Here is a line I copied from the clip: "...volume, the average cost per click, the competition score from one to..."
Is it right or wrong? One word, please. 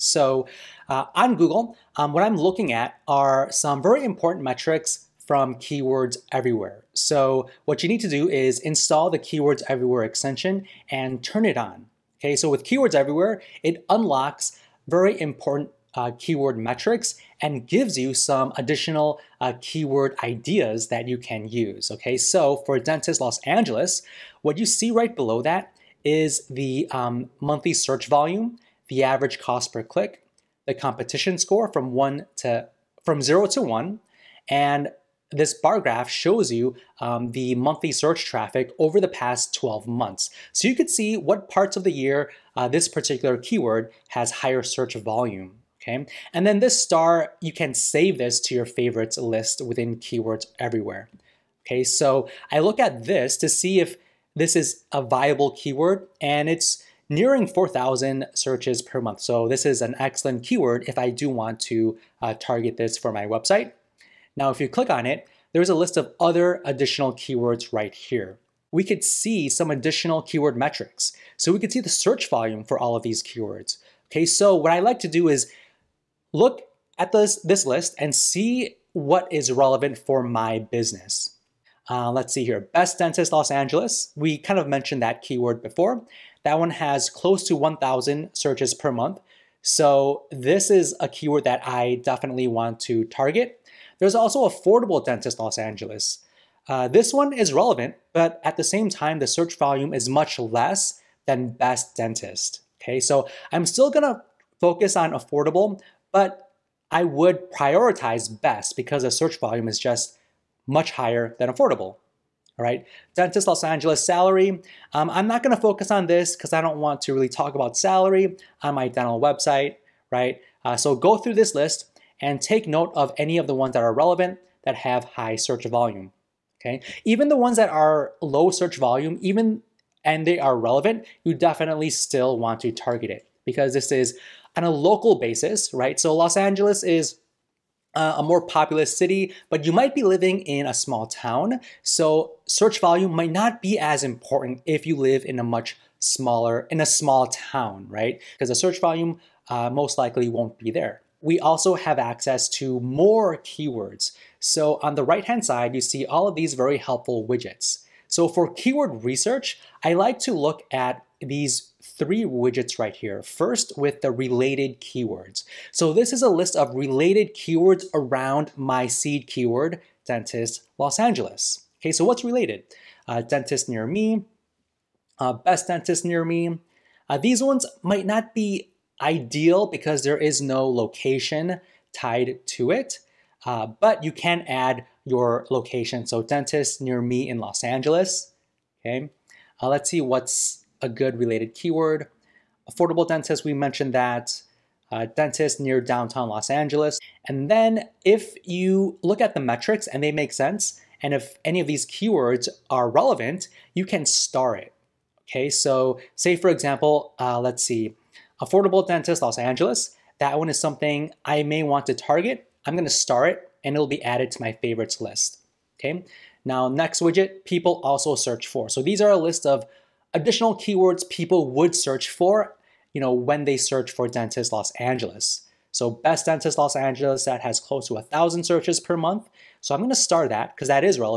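right.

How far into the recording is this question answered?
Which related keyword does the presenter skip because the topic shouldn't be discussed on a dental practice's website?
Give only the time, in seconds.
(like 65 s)
113 s.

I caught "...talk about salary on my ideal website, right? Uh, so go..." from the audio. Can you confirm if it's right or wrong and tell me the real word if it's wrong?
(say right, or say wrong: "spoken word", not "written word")
wrong: "dental", not "ideal".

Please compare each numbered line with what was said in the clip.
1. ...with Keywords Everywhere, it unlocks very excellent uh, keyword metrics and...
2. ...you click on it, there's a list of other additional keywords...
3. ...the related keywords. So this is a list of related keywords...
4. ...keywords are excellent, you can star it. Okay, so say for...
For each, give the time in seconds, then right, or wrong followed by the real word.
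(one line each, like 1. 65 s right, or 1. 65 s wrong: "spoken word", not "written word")
1. 12 s wrong: "important", not "excellent"
2. 64 s right
3. 164 s right
4. 201 s wrong: "relevant", not "excellent".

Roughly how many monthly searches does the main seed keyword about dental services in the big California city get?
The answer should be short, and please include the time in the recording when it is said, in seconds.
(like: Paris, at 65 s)
nearly 4,000, at 57 s.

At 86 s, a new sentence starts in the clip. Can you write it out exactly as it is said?
That one has close to 1,000 searches per month.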